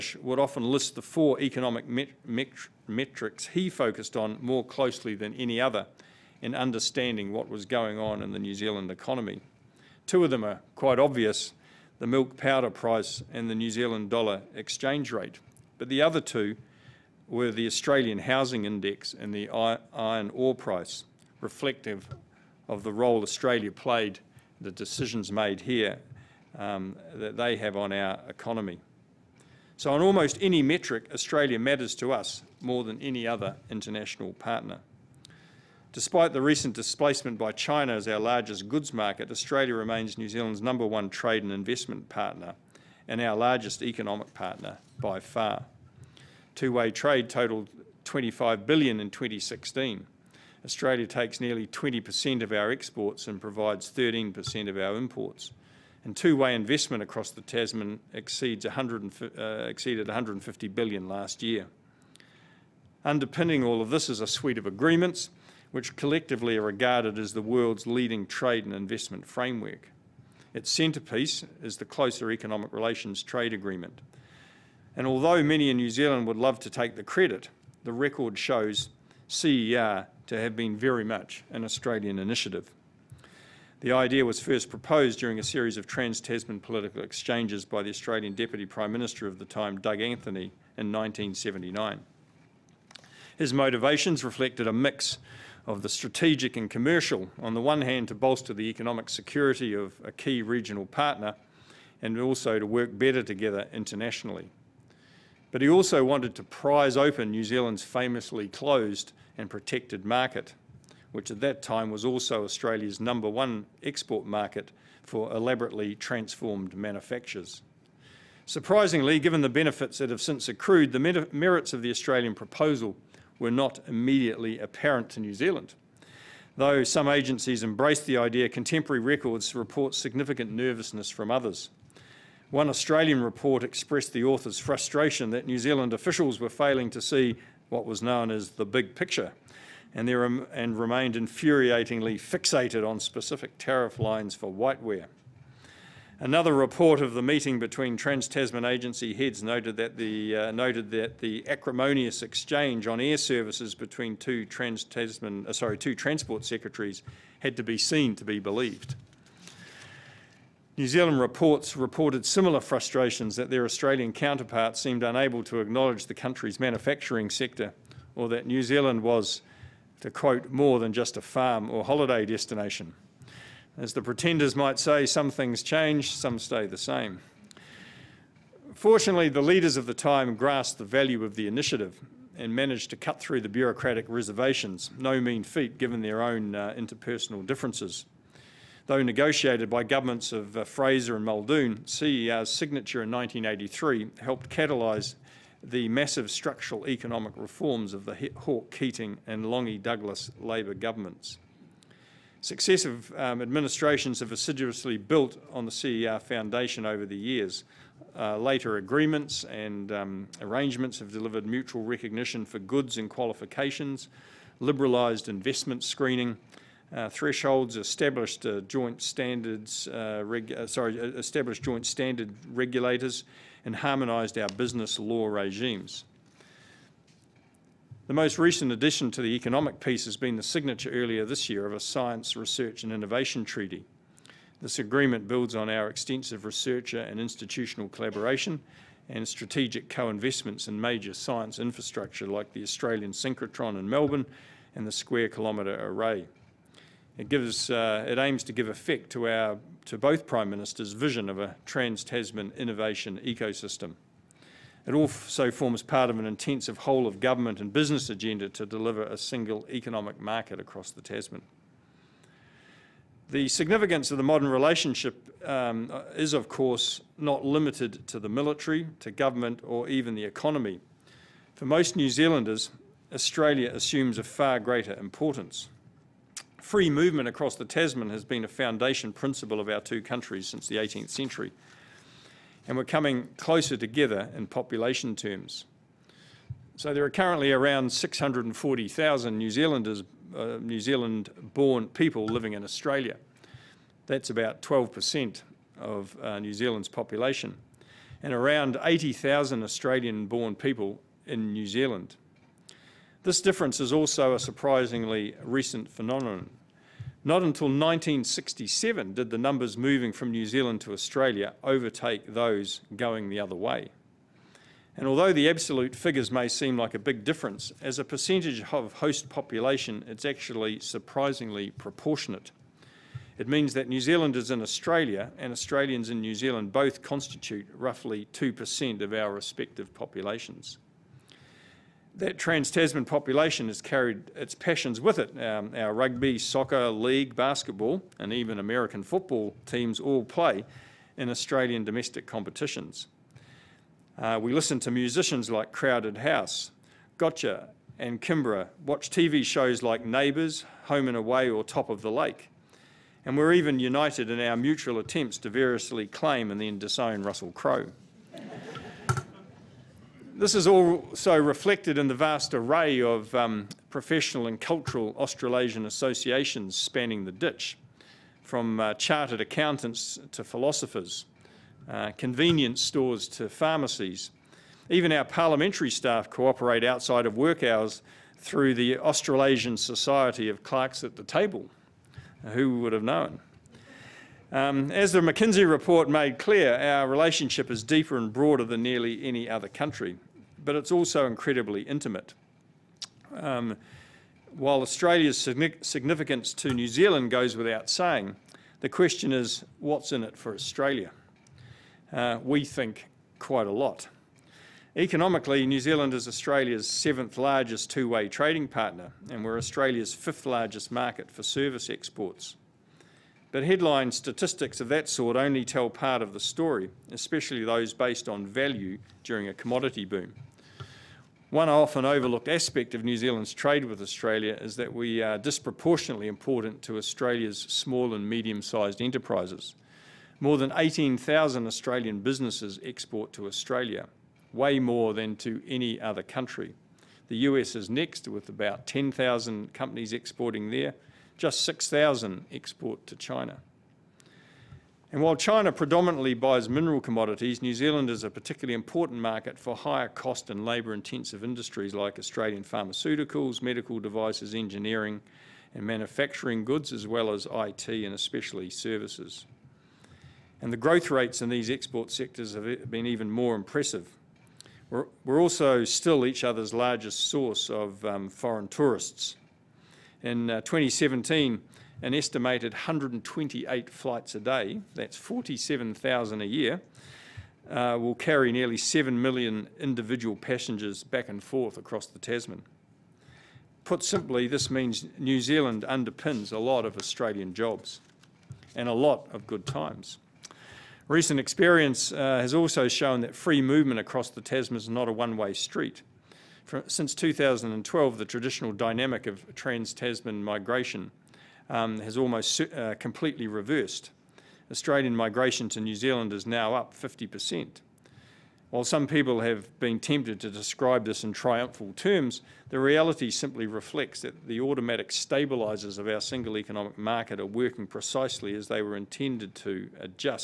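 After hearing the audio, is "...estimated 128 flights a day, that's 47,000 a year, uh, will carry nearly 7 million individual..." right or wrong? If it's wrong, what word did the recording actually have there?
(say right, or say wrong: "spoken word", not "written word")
right.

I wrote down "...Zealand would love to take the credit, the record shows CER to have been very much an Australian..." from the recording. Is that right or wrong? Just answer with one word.
right.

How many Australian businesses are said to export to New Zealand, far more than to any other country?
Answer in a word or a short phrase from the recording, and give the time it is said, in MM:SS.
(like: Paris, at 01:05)
18,000, at 07:10.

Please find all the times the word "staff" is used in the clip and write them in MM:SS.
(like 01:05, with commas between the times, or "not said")
06:15.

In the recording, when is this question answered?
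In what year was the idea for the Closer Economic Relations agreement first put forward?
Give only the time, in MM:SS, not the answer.
01:30.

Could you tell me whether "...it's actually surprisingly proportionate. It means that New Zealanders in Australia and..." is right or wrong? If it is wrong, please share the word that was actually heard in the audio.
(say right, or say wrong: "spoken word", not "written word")
right.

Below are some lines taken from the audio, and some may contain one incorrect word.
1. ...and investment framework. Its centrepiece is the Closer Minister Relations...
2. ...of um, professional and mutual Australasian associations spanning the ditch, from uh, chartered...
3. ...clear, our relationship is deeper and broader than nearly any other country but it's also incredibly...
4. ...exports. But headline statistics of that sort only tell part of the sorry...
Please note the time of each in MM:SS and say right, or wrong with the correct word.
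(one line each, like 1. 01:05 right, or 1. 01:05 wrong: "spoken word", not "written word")
1. 01:08 wrong: "Economic", not "Minister"
2. 06:03 wrong: "cultural", not "mutual"
3. 06:26 right
4. 06:51 wrong: "story", not "sorry".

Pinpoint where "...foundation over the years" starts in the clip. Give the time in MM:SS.
03:26.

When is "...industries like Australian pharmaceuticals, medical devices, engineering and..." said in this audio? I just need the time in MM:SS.
07:31.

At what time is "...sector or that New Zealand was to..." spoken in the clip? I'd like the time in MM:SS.
02:47.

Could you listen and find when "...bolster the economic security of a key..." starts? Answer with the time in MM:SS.
01:38.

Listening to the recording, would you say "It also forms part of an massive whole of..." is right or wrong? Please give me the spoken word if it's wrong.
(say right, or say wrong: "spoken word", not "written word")
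wrong: "intensive", not "massive".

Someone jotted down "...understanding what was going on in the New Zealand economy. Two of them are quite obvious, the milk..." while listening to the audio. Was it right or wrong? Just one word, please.
right.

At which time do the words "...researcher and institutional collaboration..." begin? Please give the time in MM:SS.
03:56.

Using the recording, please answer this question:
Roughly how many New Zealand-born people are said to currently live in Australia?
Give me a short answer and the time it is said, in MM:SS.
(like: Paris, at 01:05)
640,000, at 04:47.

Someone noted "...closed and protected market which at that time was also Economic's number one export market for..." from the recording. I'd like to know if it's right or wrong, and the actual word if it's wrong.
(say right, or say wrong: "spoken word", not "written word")
wrong: "Australia", not "Economic".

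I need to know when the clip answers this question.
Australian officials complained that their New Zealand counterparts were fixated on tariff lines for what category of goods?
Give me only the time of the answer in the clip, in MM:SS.
02:24.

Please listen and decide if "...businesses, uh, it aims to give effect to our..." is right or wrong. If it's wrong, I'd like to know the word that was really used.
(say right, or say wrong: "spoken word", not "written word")
wrong: "gives", not "businesses".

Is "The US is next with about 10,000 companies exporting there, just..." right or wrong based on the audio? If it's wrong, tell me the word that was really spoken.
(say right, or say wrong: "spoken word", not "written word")
right.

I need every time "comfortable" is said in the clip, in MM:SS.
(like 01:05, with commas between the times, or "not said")
not said.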